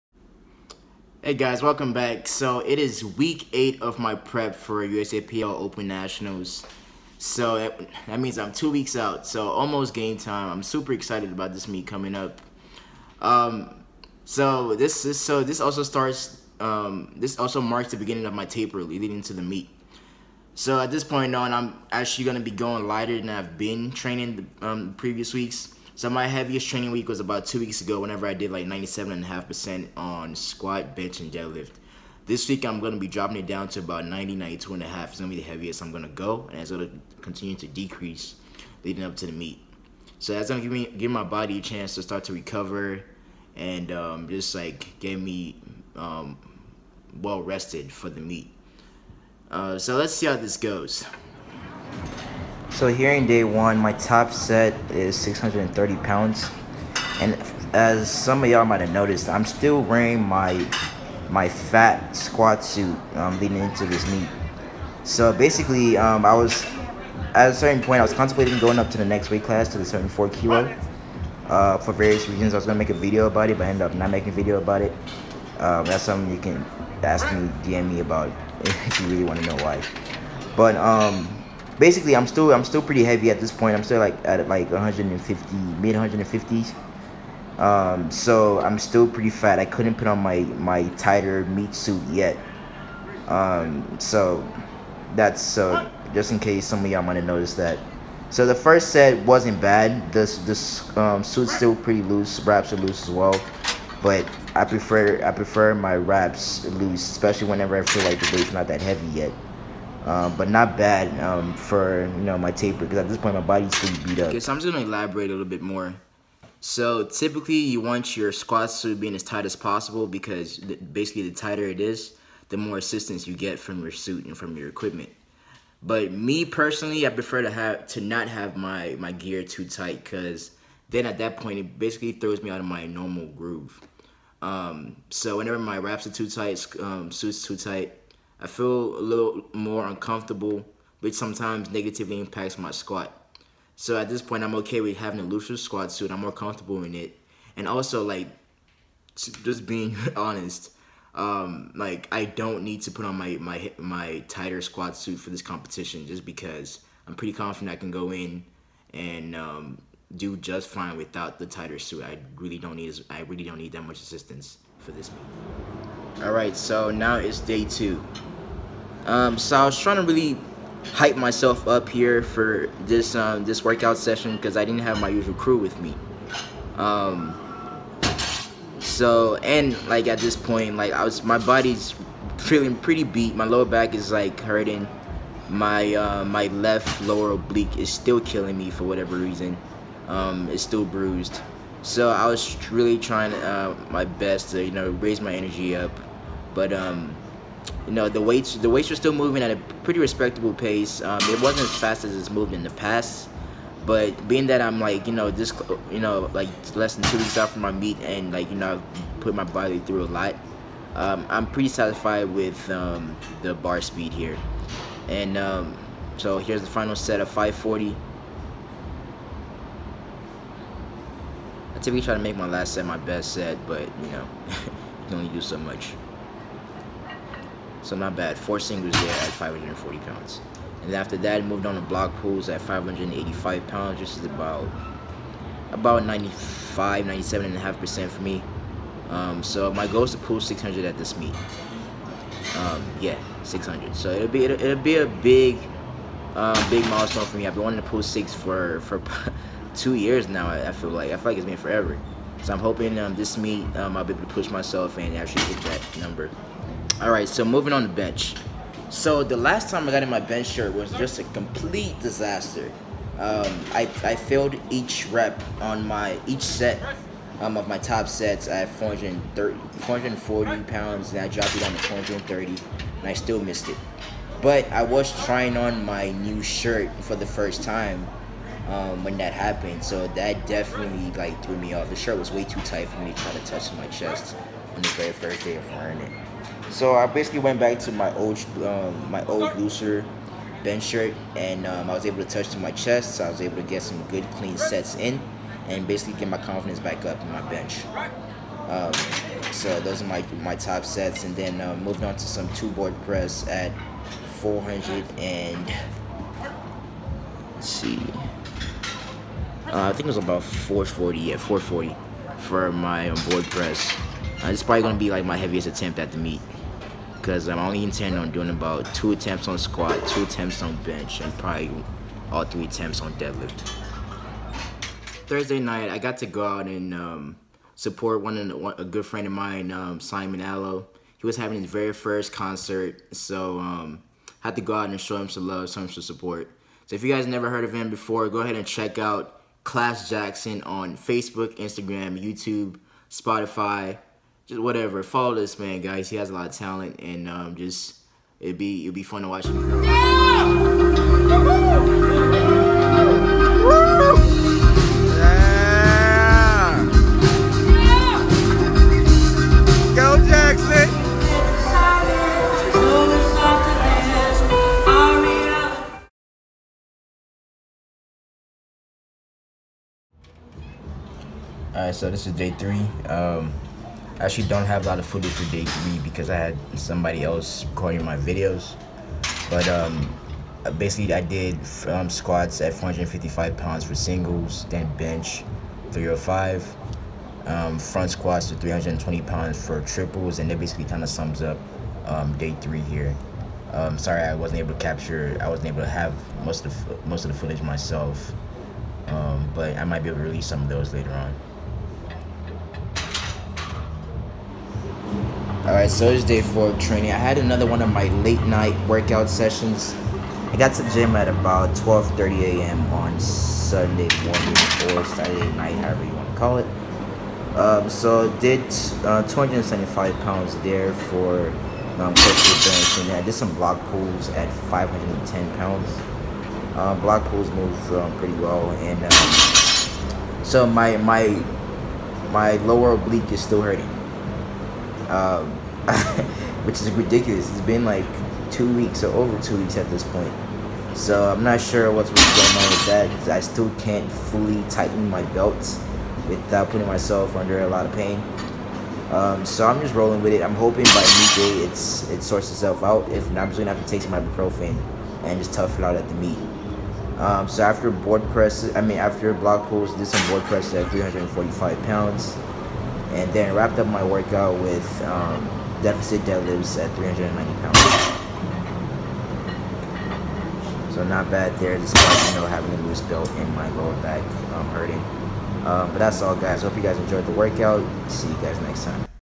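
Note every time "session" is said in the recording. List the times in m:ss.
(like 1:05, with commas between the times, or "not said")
2:53, 6:49.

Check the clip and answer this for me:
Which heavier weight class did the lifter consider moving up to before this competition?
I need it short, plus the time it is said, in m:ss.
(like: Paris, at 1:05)
74 kilo, at 1:09.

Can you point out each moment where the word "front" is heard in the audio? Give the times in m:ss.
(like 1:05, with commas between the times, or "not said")
6:27.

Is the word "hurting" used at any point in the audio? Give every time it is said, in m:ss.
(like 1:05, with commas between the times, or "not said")
3:04, 7:13, 7:54.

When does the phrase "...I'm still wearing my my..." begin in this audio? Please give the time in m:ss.
0:59.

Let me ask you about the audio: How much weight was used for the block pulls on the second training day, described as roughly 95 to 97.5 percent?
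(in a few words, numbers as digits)
585 pounds.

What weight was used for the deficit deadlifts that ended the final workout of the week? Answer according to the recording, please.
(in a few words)
390 pounds.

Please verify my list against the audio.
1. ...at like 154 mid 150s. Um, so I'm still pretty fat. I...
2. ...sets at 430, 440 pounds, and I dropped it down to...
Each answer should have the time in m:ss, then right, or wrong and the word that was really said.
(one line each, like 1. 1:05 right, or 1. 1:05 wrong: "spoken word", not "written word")
1. 1:24 wrong: "150", not "154"
2. 4:28 right.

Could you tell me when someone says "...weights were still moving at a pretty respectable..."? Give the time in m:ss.
3:18.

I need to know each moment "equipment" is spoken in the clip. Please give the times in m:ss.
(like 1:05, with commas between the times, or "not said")
2:04.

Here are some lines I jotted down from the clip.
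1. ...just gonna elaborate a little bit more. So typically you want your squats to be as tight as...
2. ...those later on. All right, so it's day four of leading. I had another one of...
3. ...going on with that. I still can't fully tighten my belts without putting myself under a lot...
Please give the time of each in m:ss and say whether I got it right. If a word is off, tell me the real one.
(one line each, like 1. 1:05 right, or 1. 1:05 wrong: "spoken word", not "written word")
1. 1:54 right
2. 6:40 wrong: "training", not "leading"
3. 7:22 right.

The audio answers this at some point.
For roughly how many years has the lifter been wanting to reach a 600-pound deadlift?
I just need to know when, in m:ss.
4:09.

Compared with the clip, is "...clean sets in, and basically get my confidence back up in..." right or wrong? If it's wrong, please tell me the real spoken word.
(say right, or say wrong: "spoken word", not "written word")
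right.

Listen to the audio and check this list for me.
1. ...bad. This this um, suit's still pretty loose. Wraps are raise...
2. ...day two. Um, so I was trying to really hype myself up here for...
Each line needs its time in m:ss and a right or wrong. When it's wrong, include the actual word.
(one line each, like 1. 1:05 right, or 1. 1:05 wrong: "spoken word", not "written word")
1. 1:39 wrong: "loose", not "raise"
2. 2:47 right.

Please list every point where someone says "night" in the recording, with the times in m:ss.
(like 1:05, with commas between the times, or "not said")
5:25, 6:48, 6:55.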